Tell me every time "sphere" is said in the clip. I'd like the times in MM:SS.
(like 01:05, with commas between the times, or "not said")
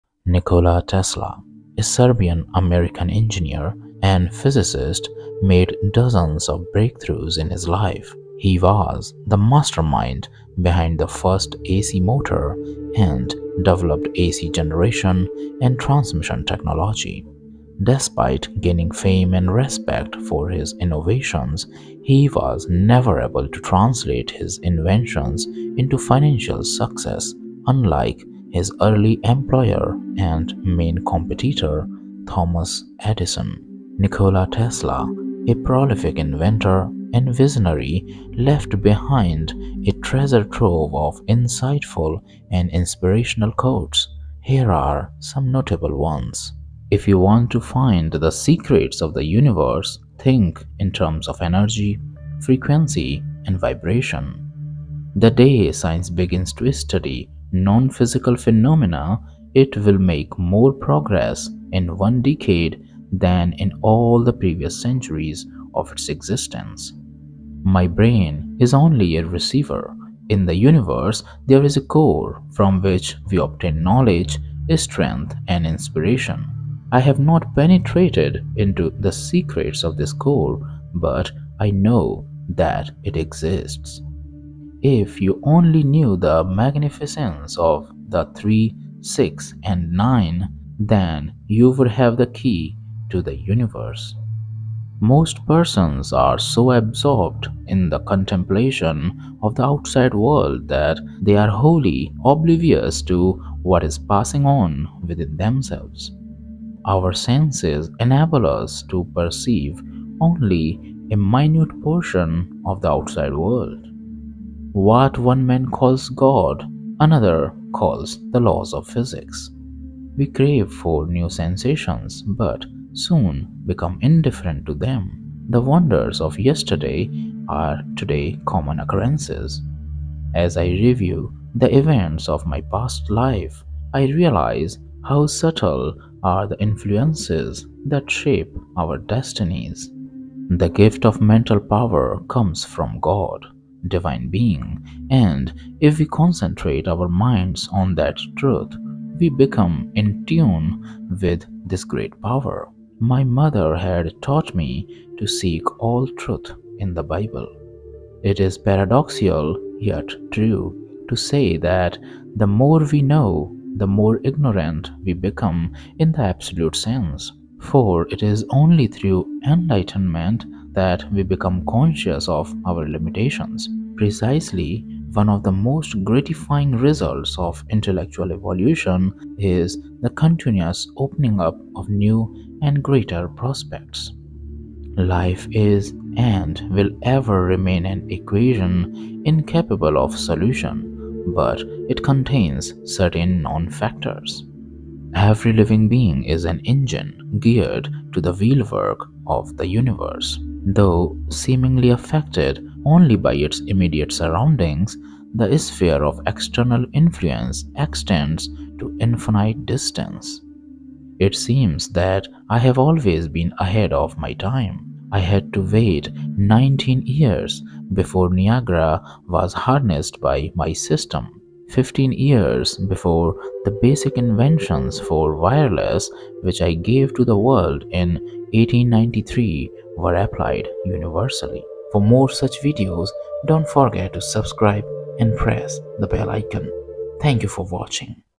03:25.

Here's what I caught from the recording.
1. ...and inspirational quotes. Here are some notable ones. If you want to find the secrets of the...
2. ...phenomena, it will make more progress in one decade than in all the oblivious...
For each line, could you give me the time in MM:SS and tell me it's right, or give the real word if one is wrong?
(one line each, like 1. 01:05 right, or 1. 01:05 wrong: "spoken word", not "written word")
1. 00:42 right
2. 00:58 wrong: "previous", not "oblivious".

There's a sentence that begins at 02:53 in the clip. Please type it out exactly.
Precisely, one of the most gratifying results of intellectual evolution is the continuous opening up of new and greater prospects.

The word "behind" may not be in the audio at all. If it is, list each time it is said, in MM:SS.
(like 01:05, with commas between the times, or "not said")
00:10, 00:38.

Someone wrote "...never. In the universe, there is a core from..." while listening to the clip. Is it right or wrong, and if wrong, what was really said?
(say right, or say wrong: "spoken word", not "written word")
wrong: "receiver", not "never".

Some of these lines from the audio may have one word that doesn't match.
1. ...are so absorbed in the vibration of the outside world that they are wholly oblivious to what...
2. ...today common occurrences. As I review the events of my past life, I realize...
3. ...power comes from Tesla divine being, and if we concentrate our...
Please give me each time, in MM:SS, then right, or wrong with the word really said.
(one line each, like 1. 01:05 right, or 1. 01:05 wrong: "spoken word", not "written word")
1. 01:36 wrong: "contemplation", not "vibration"
2. 02:07 right
3. 02:21 wrong: "God", not "Tesla".